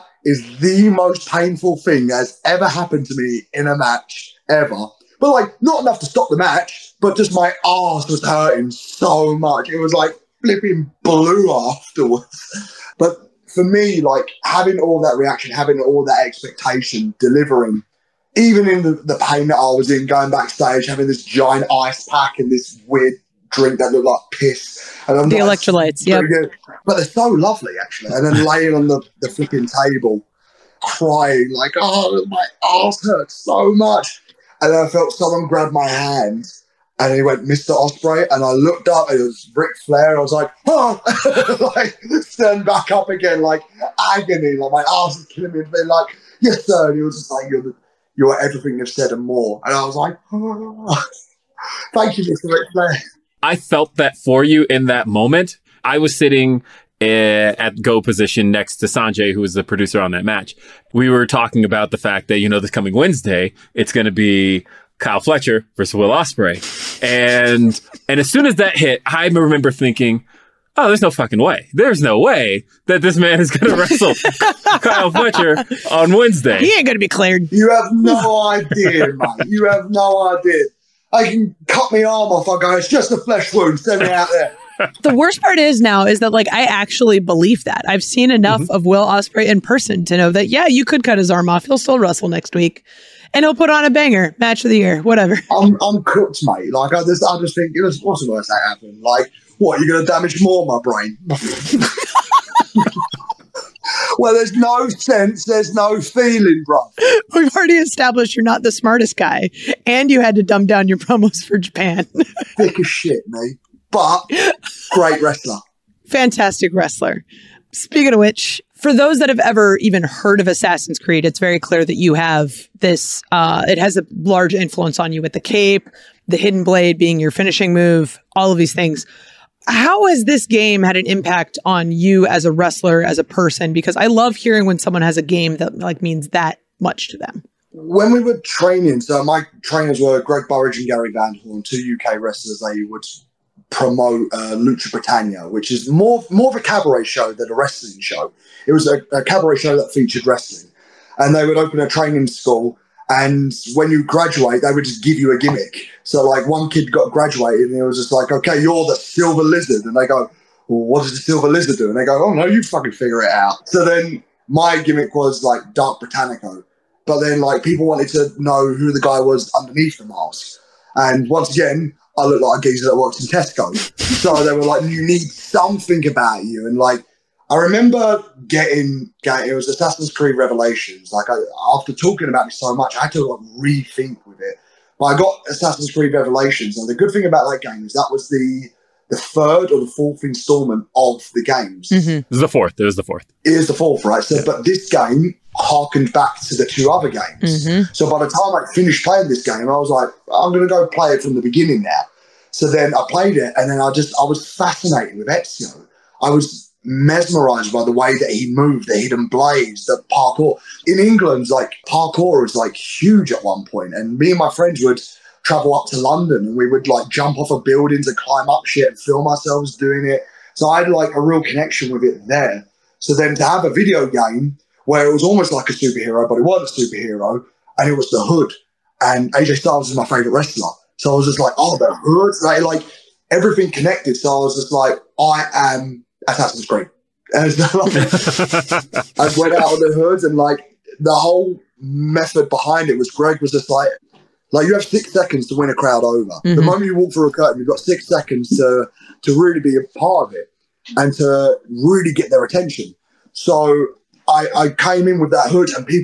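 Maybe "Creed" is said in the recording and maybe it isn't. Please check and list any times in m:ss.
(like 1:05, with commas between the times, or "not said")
2:00, 3:00, 3:05, 3:56.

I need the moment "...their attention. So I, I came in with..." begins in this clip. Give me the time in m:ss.
4:12.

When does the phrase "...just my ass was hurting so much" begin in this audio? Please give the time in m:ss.
0:07.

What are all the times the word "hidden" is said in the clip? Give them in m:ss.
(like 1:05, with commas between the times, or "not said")
2:06, 3:28.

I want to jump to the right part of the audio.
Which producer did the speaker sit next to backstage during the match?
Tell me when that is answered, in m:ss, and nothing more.
0:58.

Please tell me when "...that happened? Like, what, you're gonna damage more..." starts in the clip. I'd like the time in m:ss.
1:38.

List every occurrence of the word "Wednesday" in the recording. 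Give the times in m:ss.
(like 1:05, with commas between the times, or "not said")
1:02, 1:16.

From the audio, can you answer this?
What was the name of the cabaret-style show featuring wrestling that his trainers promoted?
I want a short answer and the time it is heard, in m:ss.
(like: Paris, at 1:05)
Lucha Britannia, at 2:24.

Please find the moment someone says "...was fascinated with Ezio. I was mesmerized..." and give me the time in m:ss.
3:24.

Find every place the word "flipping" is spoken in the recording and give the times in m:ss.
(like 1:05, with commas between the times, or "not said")
0:10, 0:29.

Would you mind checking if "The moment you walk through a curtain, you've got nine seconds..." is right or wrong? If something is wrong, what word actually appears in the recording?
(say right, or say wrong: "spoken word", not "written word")
wrong: "six", not "nine".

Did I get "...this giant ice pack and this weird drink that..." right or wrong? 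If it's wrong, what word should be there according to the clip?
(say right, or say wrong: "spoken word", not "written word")
right.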